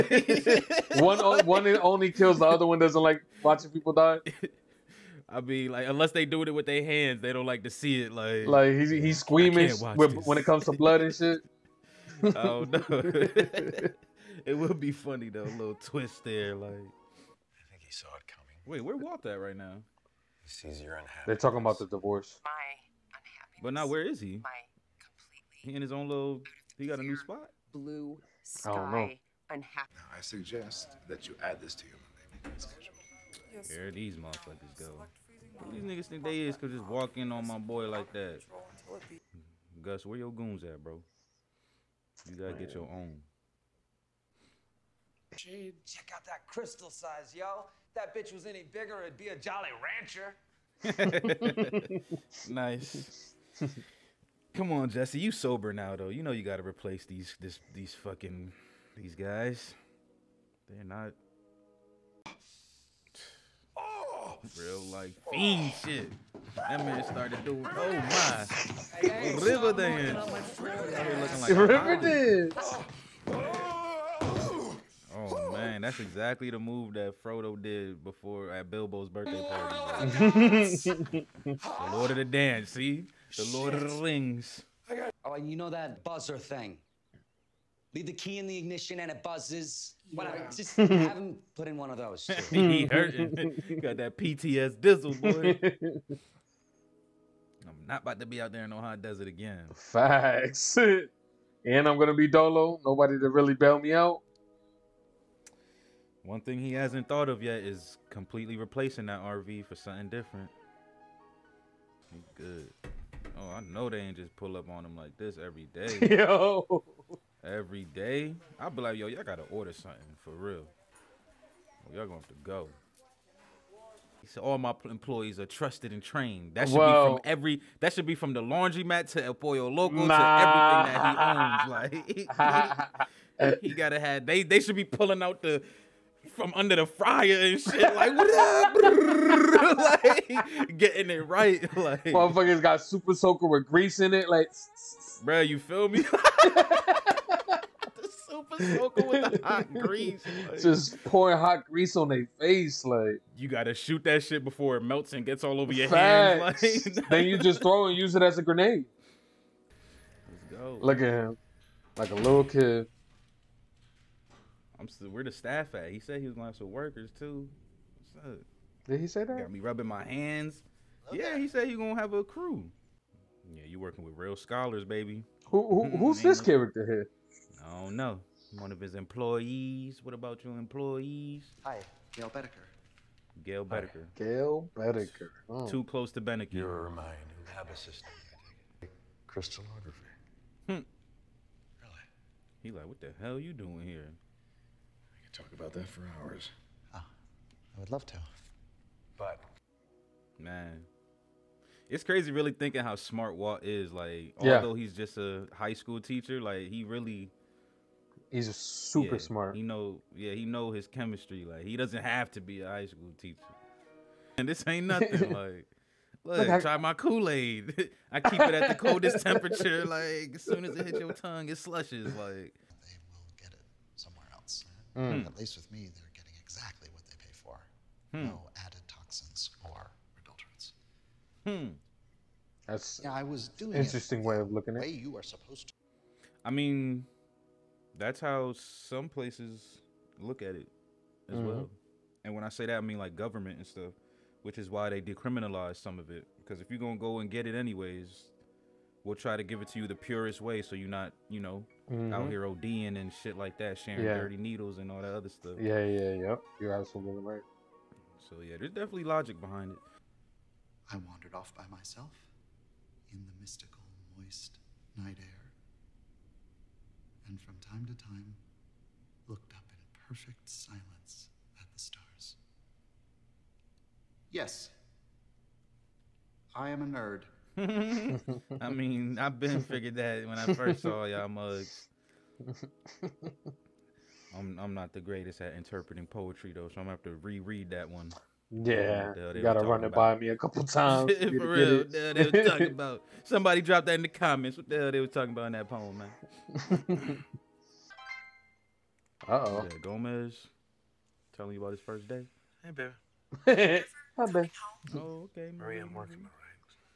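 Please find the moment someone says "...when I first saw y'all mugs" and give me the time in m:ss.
4:40.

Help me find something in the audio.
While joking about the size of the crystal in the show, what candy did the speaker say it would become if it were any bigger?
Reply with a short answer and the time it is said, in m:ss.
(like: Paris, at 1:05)
Jolly Rancher, at 0:49.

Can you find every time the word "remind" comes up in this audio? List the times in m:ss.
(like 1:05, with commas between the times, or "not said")
not said.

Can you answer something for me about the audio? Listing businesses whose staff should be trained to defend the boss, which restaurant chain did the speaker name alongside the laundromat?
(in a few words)
El Pollo Loco.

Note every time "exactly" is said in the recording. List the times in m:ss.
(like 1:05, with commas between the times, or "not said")
1:15, 3:46.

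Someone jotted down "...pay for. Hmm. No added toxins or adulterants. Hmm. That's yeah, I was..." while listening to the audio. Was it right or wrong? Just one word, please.
right.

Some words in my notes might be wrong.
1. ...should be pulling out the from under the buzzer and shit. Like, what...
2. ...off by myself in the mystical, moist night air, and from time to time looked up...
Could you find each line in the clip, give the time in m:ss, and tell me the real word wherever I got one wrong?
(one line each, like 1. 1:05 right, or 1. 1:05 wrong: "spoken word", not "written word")
1. 2:14 wrong: "fryer", not "buzzer"
2. 4:21 right.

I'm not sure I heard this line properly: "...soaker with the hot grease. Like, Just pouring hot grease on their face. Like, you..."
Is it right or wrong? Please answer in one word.
right.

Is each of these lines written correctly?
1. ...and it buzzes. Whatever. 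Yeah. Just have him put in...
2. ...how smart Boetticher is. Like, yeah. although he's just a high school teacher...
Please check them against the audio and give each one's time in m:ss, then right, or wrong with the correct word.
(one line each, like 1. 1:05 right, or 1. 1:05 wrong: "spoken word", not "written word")
1. 1:28 right
2. 3:22 wrong: "Walt", not "Boetticher".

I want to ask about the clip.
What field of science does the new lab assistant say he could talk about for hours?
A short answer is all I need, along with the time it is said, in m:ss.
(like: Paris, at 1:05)
Crystallography, at 3:09.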